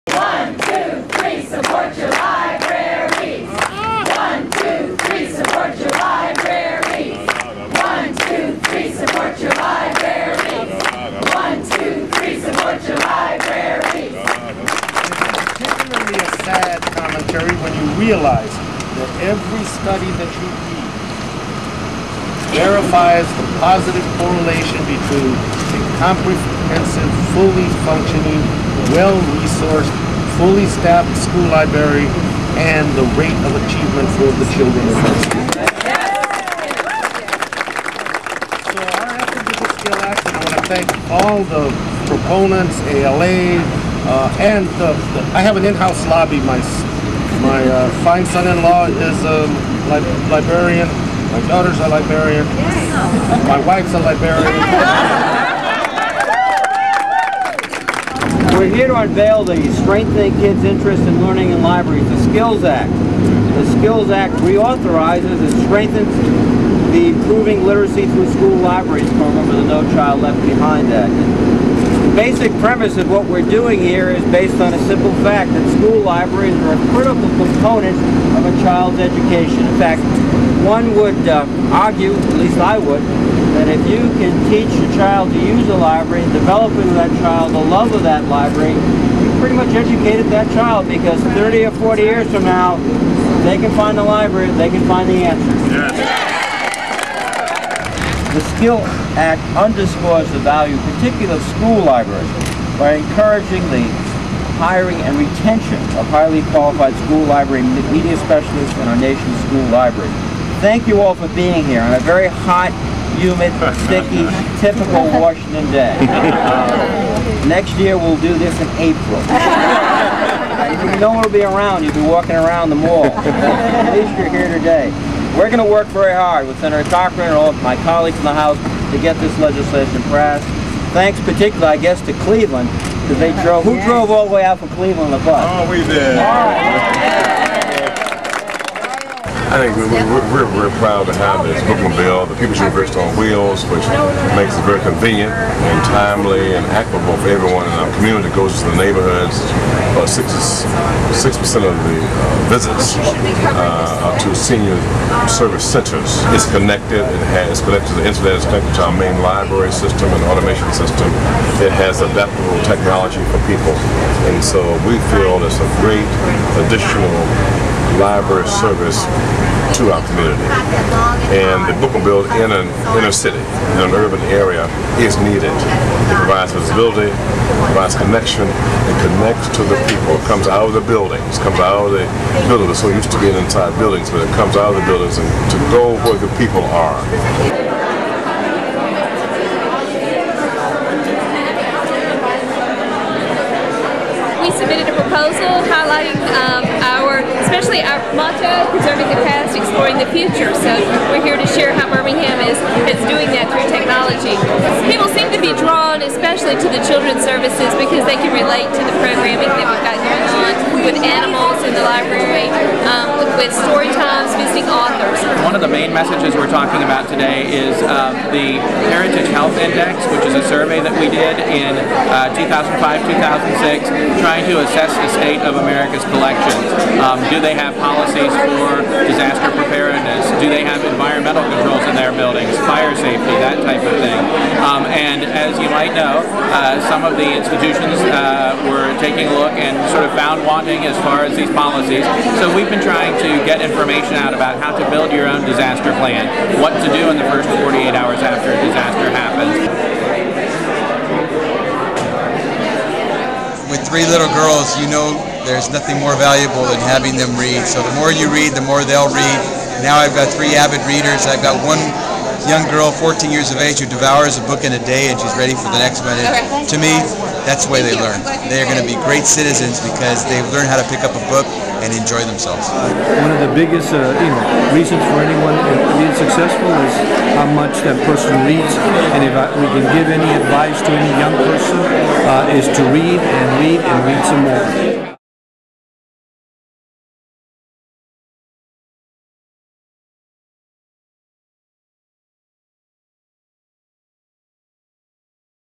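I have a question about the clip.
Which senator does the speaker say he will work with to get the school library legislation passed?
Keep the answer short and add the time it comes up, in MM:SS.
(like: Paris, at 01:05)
Senator Cochran, at 02:06.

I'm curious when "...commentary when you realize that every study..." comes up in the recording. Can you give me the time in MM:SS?
00:16.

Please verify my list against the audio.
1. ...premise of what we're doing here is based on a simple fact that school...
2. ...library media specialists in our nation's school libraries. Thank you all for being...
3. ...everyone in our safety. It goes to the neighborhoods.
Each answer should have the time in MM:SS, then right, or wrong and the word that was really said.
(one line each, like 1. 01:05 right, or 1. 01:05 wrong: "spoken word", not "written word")
1. 01:12 right
2. 01:47 right
3. 02:27 wrong: "community", not "safety".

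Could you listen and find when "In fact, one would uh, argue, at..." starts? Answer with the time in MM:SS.
01:19.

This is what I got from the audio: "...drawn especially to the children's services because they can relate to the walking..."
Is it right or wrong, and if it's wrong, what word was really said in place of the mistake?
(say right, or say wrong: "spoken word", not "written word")
wrong: "programming", not "walking".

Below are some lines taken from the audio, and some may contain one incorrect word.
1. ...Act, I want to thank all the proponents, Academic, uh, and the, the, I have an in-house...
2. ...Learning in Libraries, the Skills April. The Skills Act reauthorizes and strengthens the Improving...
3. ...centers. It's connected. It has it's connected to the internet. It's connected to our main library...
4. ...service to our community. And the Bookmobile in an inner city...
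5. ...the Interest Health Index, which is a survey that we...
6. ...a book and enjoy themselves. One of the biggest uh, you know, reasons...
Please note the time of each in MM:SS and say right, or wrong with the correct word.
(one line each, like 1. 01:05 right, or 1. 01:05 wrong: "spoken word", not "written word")
1. 00:39 wrong: "ALA", not "Academic"
2. 01:01 wrong: "Act", not "April"
3. 02:35 right
4. 02:48 right
5. 03:38 wrong: "Heritage", not "Interest"
6. 04:31 right.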